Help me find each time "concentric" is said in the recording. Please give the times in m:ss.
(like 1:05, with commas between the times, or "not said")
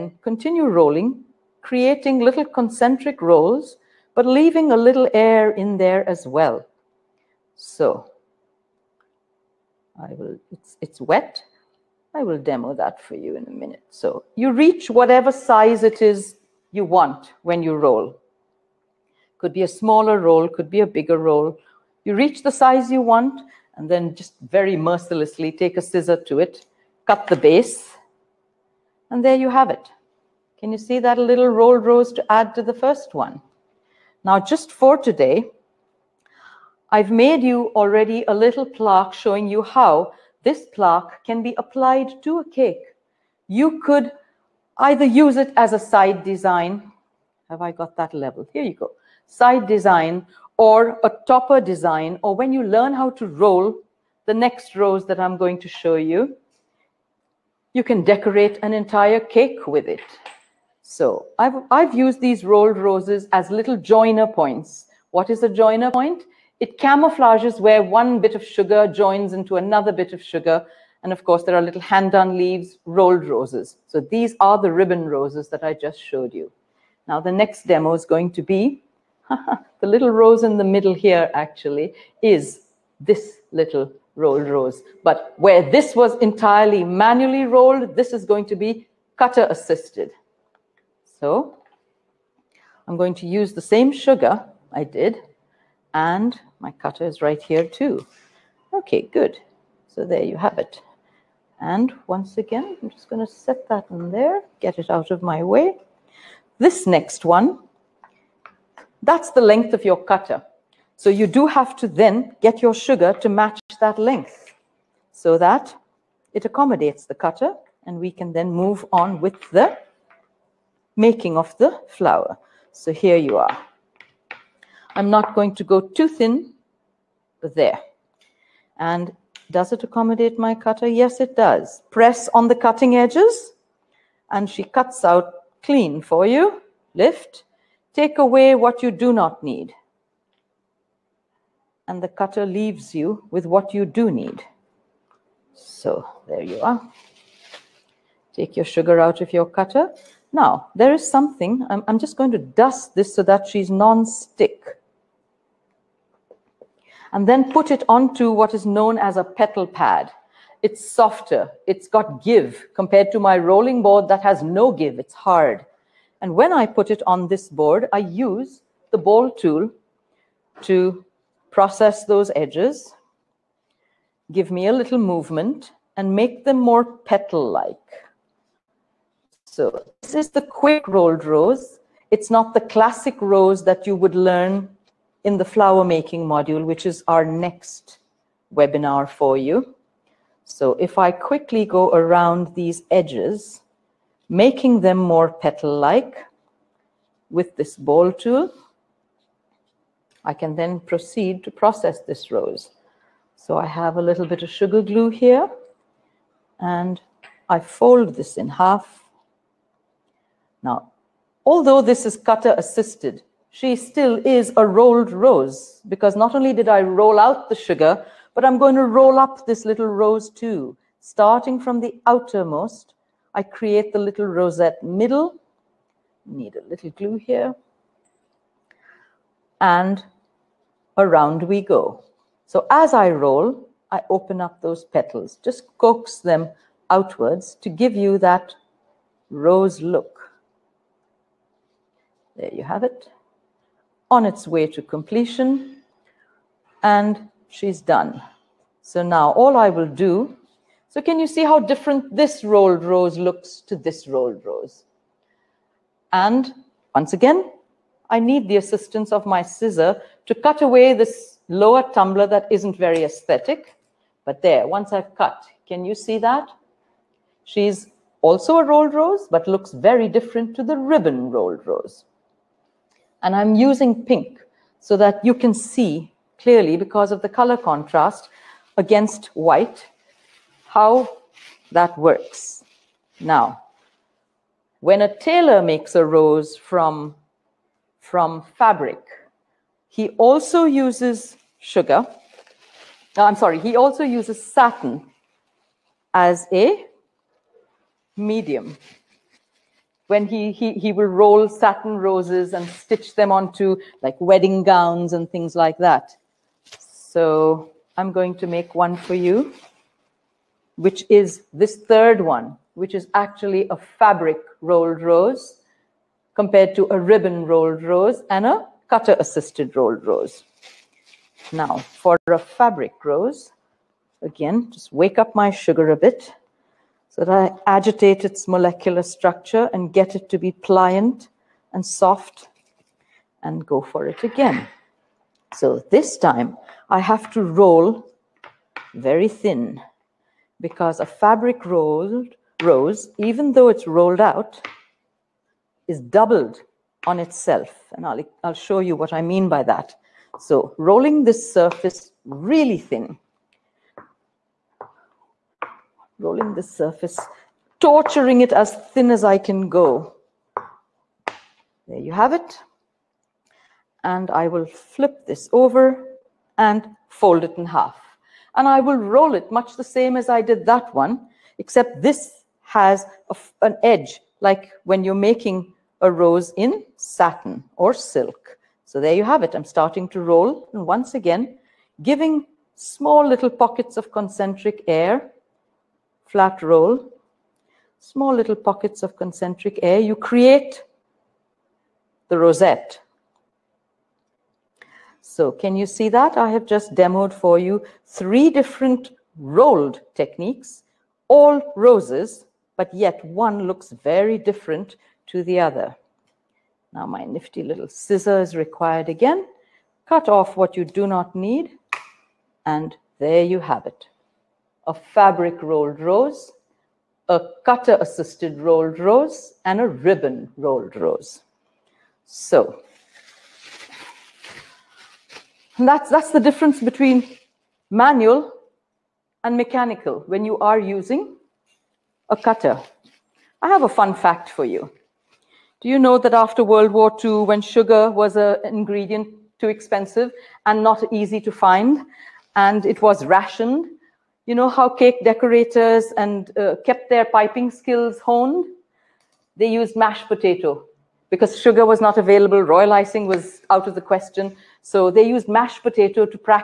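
0:02, 6:24, 6:29.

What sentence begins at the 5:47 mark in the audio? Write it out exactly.
And I'll, I'll show you what I mean by that.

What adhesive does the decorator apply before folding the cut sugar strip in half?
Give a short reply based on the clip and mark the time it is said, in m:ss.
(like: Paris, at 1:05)
sugar glue, at 3:24.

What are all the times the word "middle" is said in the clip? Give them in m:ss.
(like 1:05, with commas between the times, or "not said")
1:20, 3:44.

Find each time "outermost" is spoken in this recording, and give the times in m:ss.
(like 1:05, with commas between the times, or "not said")
3:42.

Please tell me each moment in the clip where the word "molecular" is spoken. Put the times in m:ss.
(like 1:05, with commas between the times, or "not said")
5:28.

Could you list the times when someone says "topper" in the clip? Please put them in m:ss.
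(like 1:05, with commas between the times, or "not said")
0:51.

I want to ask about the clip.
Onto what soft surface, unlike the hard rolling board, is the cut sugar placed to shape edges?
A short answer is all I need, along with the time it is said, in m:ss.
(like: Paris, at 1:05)
petal pad, at 2:39.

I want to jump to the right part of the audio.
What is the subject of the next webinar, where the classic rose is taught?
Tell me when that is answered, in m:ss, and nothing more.
3:05.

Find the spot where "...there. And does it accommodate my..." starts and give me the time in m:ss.
2:07.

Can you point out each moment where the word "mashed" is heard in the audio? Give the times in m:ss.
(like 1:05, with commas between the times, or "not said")
7:29, 7:35.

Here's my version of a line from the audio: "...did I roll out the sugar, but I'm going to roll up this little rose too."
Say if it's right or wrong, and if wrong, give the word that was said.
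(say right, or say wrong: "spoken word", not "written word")
right.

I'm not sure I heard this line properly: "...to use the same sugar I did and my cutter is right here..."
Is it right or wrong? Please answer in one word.
right.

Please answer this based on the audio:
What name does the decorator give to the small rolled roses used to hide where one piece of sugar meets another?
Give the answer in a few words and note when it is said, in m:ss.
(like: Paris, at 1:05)
joiner points, at 1:03.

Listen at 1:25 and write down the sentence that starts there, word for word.
But where this was entirely manually rolled, this is going to be cutter assisted.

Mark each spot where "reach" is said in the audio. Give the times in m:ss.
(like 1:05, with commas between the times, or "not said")
0:14, 0:22.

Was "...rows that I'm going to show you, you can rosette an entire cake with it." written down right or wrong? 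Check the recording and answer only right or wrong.
wrong.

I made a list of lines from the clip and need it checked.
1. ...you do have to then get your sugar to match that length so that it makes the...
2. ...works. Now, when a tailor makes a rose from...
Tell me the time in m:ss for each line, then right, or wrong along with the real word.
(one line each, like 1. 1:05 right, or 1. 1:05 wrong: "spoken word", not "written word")
1. 1:51 wrong: "accommodates", not "makes"
2. 4:41 right.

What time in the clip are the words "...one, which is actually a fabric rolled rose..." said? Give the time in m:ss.
5:12.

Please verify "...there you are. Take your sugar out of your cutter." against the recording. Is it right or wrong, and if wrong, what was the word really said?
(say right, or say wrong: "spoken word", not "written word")
right.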